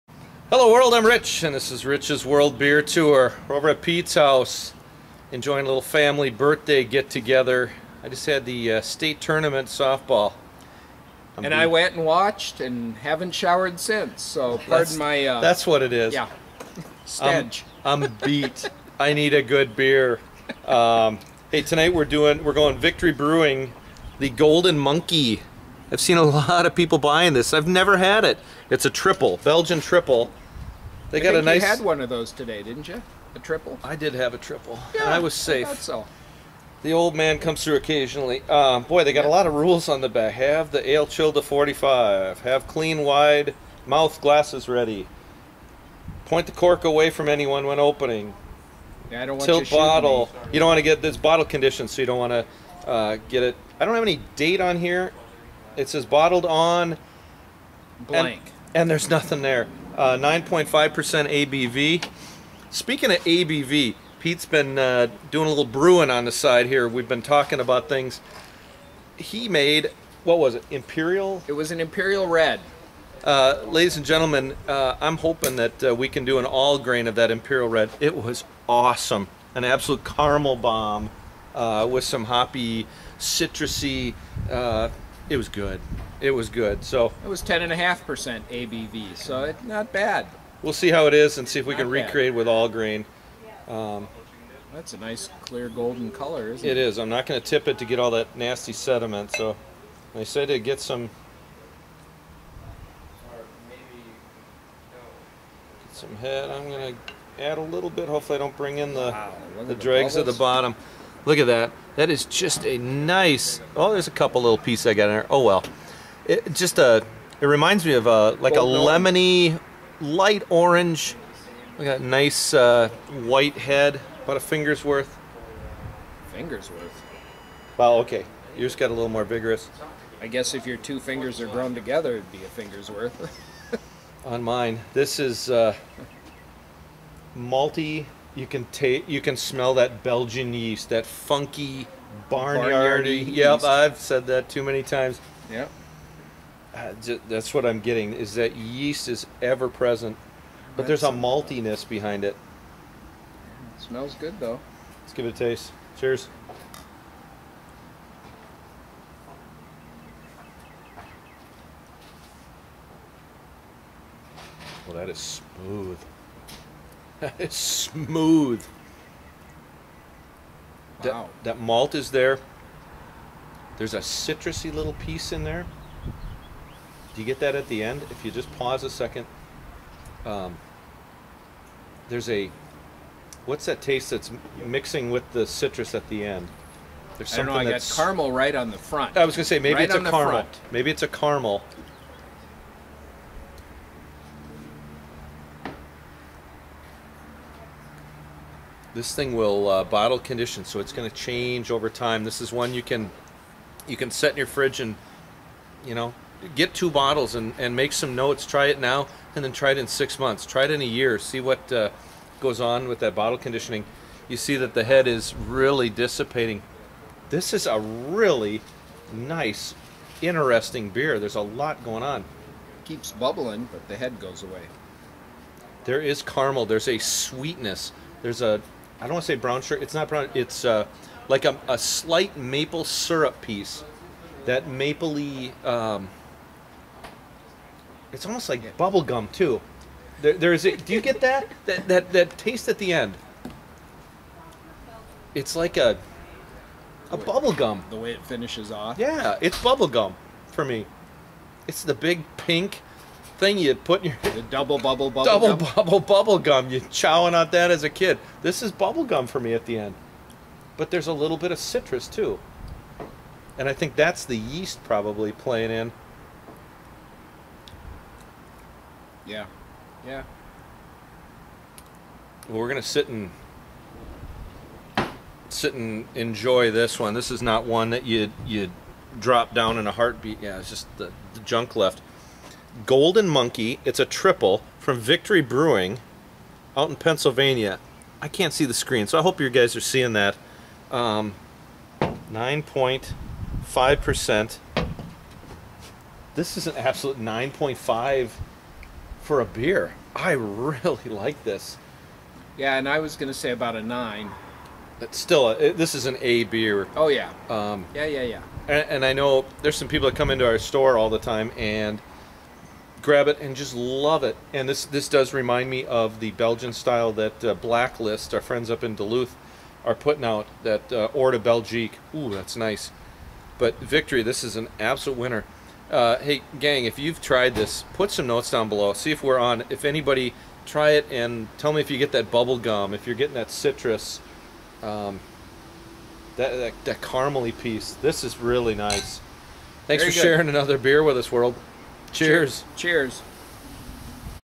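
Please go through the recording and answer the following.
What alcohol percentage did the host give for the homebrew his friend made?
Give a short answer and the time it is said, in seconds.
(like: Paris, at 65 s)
10.5%, at 87 s.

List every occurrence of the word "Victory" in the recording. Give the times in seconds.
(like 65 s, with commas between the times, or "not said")
22 s, 284 s, 323 s.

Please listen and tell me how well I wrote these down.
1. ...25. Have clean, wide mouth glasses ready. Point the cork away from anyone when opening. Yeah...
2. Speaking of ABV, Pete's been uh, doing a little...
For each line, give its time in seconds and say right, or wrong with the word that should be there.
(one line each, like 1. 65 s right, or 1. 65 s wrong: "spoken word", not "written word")
1. 41 s wrong: "45", not "25"
2. 62 s right.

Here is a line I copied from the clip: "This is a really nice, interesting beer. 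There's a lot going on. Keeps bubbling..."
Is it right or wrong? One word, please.
right.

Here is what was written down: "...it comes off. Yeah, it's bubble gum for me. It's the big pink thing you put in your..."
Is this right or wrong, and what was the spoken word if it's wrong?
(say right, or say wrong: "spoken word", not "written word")
wrong: "finishes", not "comes".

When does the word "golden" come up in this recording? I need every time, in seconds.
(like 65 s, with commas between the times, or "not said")
24 s, 95 s, 282 s.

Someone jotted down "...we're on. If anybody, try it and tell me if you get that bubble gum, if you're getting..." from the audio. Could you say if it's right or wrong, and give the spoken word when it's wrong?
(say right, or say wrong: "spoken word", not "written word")
right.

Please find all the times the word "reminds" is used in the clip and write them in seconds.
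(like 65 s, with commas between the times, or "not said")
117 s, 315 s.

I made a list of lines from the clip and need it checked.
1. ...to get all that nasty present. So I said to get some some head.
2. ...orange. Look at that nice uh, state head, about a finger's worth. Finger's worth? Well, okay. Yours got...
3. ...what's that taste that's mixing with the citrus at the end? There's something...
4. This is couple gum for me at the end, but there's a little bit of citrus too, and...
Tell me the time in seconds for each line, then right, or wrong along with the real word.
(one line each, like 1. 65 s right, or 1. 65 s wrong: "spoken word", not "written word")
1. 97 s wrong: "sediment", not "present"
2. 120 s wrong: "white", not "state"
3. 183 s right
4. 258 s wrong: "bubble", not "couple".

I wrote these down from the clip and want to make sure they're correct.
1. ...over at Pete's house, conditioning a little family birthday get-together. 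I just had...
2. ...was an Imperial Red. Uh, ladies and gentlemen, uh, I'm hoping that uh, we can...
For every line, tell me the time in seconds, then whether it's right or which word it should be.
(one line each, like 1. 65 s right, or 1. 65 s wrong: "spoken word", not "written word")
1. 3 s wrong: "enjoying", not "conditioning"
2. 71 s right.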